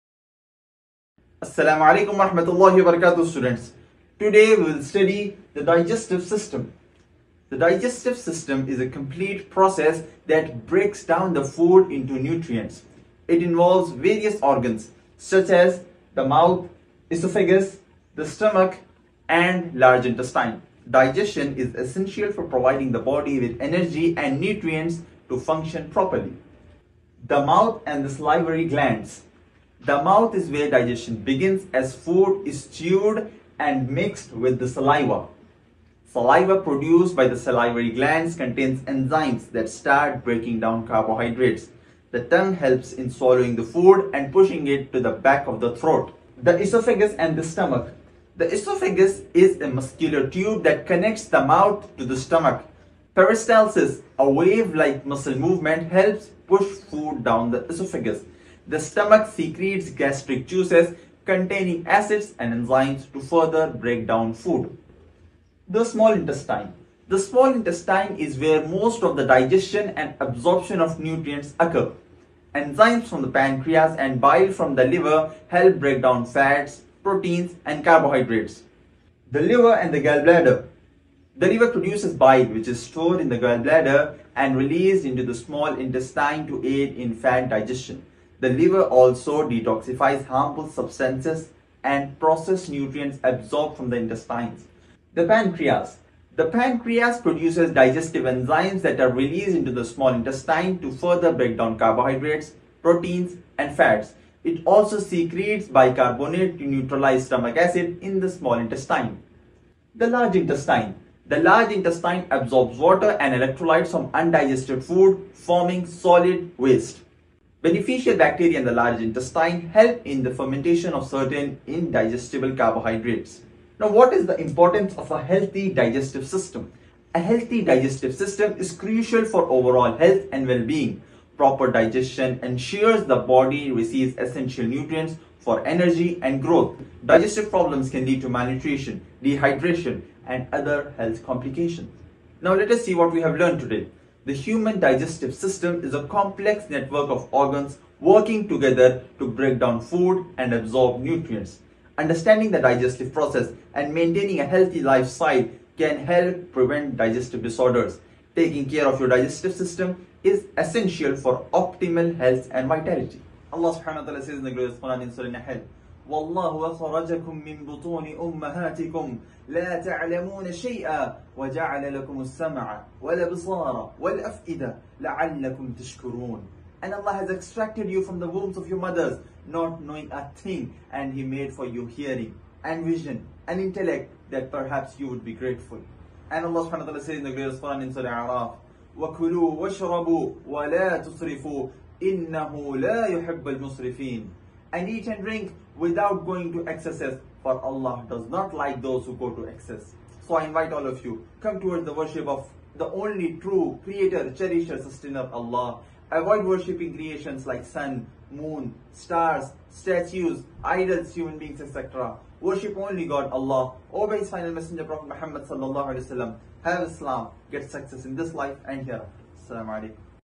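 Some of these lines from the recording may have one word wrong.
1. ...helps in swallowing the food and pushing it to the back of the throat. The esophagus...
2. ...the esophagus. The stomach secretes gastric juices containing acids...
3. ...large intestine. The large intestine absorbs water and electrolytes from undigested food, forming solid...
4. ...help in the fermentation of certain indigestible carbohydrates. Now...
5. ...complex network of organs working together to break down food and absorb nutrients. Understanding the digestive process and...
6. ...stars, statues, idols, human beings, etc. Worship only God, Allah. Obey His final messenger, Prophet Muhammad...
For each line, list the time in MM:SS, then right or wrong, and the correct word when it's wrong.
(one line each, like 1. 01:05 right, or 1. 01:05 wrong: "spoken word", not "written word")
1. 00:42 right
2. 00:57 right
3. 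01:50 right
4. 01:59 right
5. 02:26 right
6. 03:28 right.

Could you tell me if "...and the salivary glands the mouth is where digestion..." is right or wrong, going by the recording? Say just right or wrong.
right.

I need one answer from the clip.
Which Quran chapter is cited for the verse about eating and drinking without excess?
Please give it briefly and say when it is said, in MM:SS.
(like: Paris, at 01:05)
Surah Araf, at 03:07.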